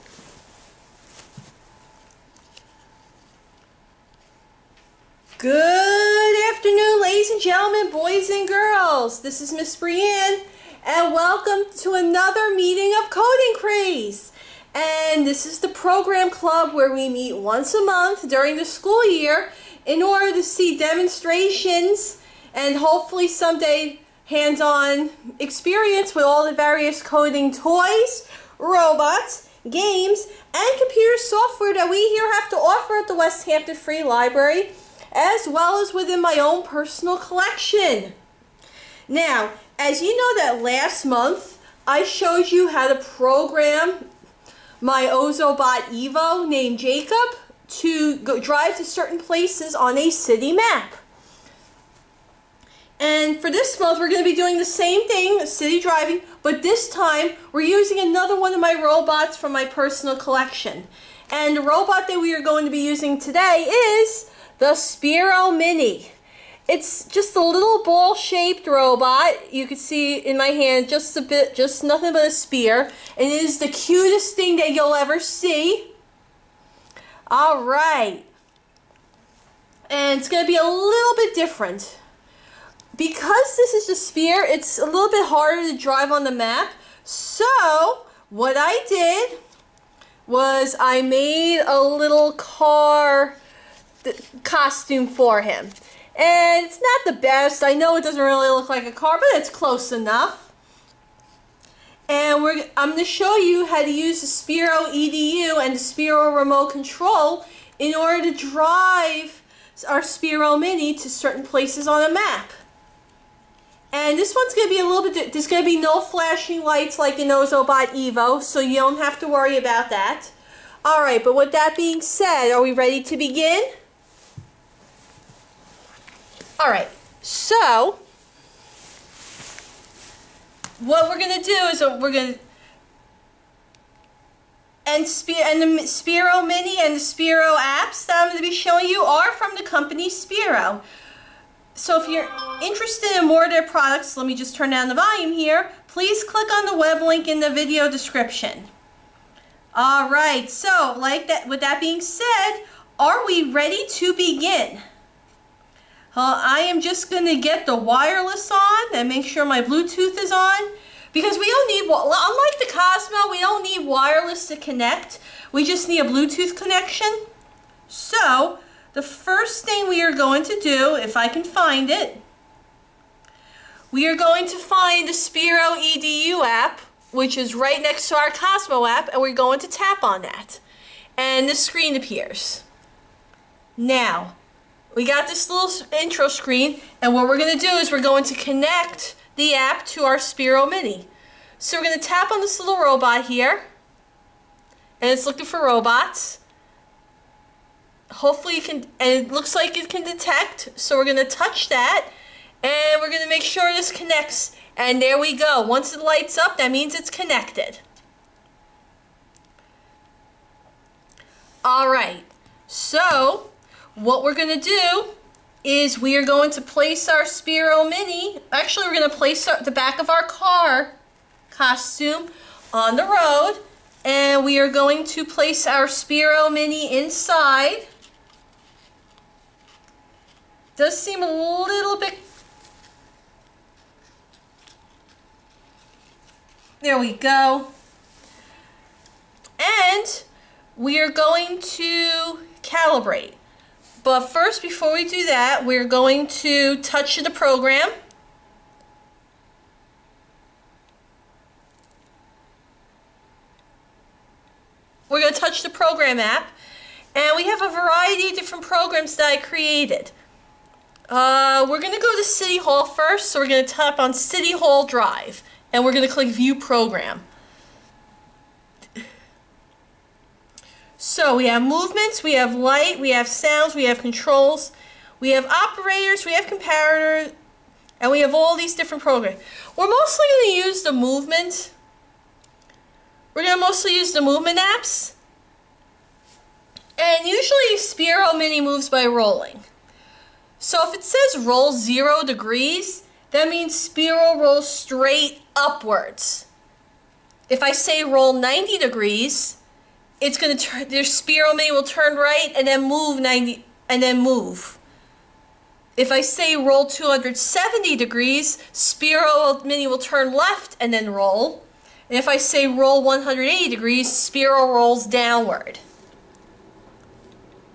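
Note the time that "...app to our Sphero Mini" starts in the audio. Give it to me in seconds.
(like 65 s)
189 s.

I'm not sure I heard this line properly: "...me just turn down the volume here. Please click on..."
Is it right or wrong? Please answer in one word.
right.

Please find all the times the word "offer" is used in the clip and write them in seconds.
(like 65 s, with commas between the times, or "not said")
32 s.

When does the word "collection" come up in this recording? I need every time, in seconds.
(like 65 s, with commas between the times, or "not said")
37 s, 60 s.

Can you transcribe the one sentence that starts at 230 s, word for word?
Does seem a little bit, there we go.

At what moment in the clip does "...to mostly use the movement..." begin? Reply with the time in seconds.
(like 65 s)
283 s.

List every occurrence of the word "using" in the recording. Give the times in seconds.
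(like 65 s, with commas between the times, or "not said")
57 s, 62 s.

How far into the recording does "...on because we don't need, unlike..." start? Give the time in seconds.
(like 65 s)
160 s.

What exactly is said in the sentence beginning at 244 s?
But first, before we do that, we're going to touch the program.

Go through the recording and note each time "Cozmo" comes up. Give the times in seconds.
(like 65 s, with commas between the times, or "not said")
162 s, 178 s.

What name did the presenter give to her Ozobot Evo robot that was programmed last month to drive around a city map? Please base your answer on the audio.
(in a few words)
Jacob.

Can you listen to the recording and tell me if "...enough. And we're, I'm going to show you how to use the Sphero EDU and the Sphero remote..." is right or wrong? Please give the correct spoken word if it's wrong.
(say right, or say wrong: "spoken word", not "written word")
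right.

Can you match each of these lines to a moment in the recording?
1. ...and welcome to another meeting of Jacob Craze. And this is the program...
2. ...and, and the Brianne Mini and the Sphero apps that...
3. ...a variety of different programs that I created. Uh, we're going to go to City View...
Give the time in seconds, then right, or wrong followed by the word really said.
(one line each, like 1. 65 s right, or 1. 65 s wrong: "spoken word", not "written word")
1. 10 s wrong: "Coding", not "Jacob"
2. 134 s wrong: "Sphero", not "Brianne"
3. 257 s wrong: "Hall", not "View".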